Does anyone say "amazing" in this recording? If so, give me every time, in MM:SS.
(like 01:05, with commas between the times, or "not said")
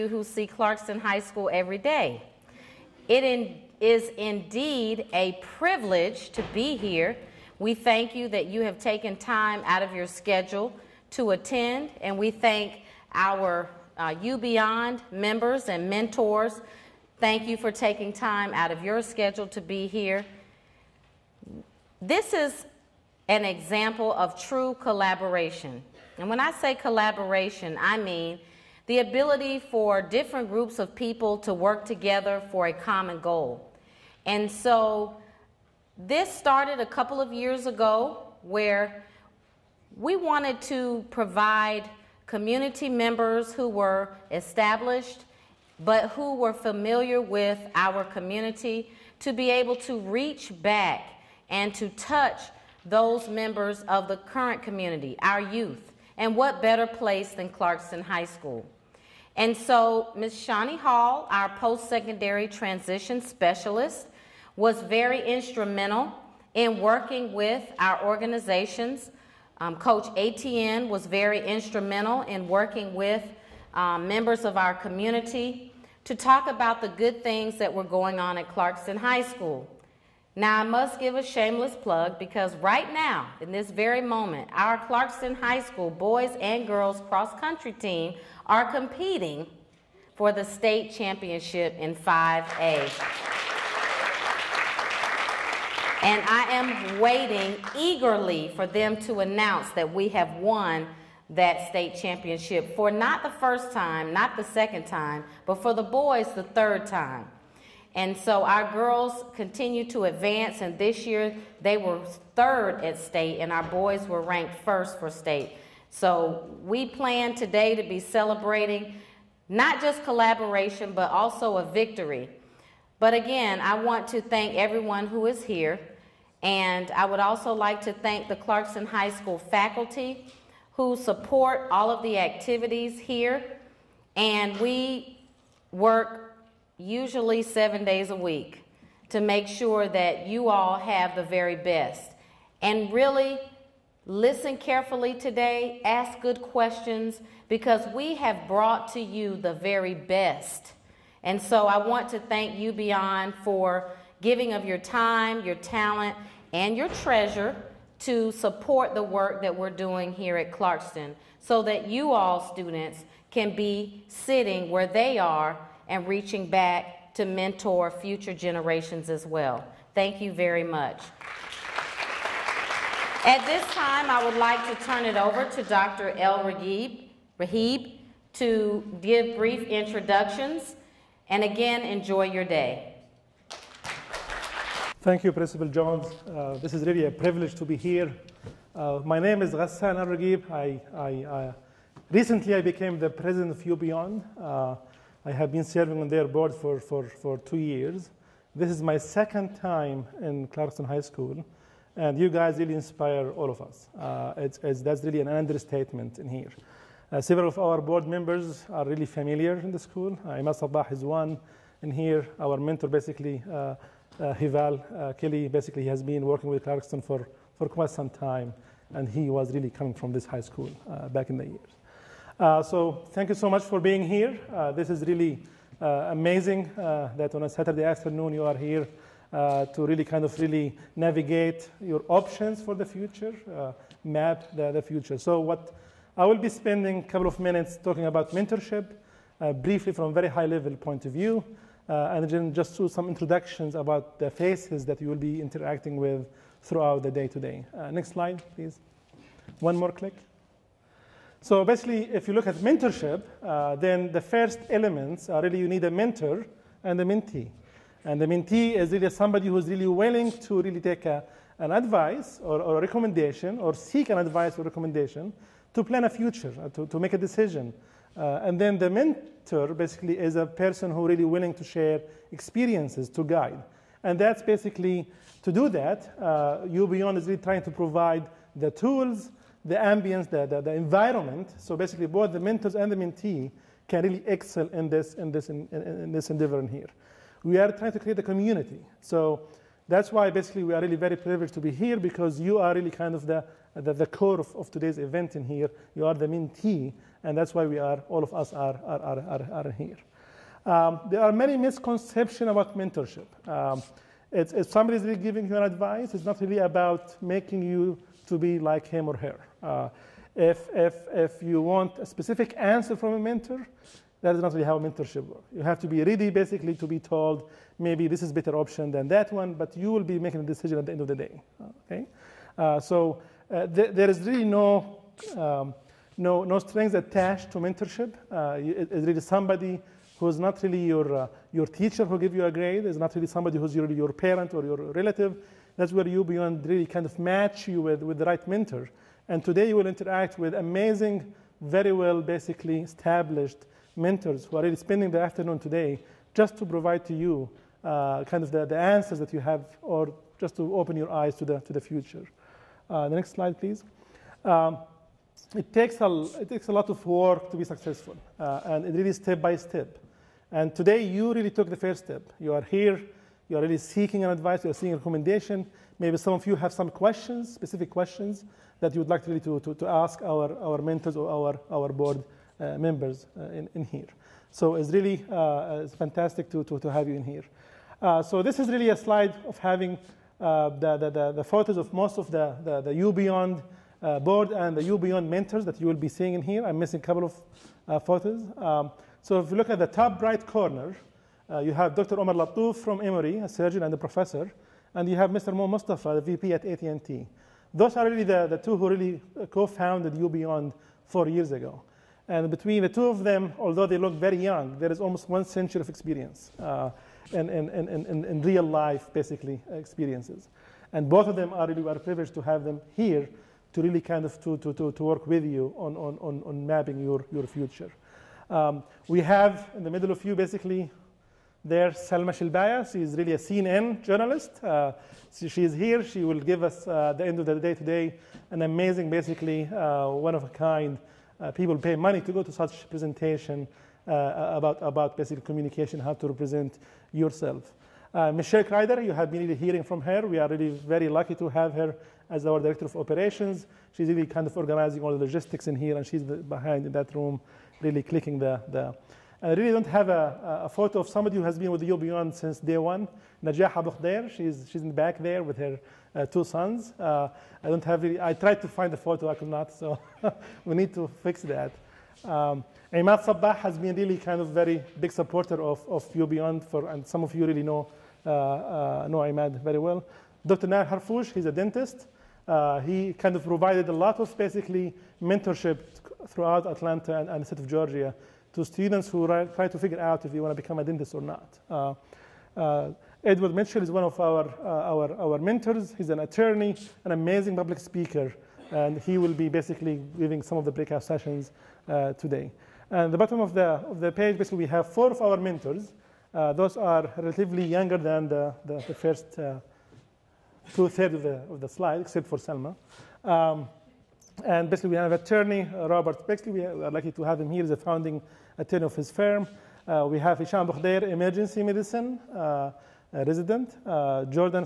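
03:46, 05:40, 07:08, 08:07.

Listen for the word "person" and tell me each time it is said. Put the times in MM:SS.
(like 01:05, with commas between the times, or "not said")
04:30.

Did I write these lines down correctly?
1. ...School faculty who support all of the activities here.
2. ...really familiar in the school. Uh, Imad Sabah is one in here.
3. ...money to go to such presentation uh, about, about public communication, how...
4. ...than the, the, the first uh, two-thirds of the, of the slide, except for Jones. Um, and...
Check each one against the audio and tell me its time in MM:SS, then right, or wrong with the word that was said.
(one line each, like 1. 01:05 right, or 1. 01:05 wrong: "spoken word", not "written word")
1. 02:09 right
2. 03:28 right
3. 07:11 wrong: "basic", not "public"
4. 08:17 wrong: "Selma", not "Jones".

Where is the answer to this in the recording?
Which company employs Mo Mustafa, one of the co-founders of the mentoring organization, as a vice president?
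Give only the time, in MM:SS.
06:36.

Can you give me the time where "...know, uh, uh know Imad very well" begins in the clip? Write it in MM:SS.
07:47.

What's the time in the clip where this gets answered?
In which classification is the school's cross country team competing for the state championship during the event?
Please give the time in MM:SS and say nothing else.
01:31.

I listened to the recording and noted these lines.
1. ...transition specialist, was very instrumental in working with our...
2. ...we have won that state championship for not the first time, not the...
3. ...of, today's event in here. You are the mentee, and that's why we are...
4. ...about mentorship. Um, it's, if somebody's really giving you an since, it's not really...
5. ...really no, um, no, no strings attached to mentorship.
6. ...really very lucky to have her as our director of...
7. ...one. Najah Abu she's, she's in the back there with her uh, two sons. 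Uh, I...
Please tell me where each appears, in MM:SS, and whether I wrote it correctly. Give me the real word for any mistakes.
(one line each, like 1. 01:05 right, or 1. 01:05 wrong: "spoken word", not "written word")
1. 01:02 right
2. 01:39 right
3. 04:54 right
4. 05:02 wrong: "advice", not "since"
5. 05:24 right
6. 07:20 right
7. 07:32 right.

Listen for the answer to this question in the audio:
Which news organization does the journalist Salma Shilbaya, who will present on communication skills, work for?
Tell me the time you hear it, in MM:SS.
07:03.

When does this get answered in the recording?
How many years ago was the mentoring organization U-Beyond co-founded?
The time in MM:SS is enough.
06:41.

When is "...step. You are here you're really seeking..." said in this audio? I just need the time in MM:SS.
06:02.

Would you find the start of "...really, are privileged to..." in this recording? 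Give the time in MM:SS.
06:51.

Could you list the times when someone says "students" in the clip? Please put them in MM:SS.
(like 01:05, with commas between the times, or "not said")
02:42, 07:58.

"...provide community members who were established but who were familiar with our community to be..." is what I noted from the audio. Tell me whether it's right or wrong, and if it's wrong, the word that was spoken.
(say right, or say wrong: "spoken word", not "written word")
right.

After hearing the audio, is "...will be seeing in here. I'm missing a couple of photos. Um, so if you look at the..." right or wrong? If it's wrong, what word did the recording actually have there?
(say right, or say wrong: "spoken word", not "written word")
right.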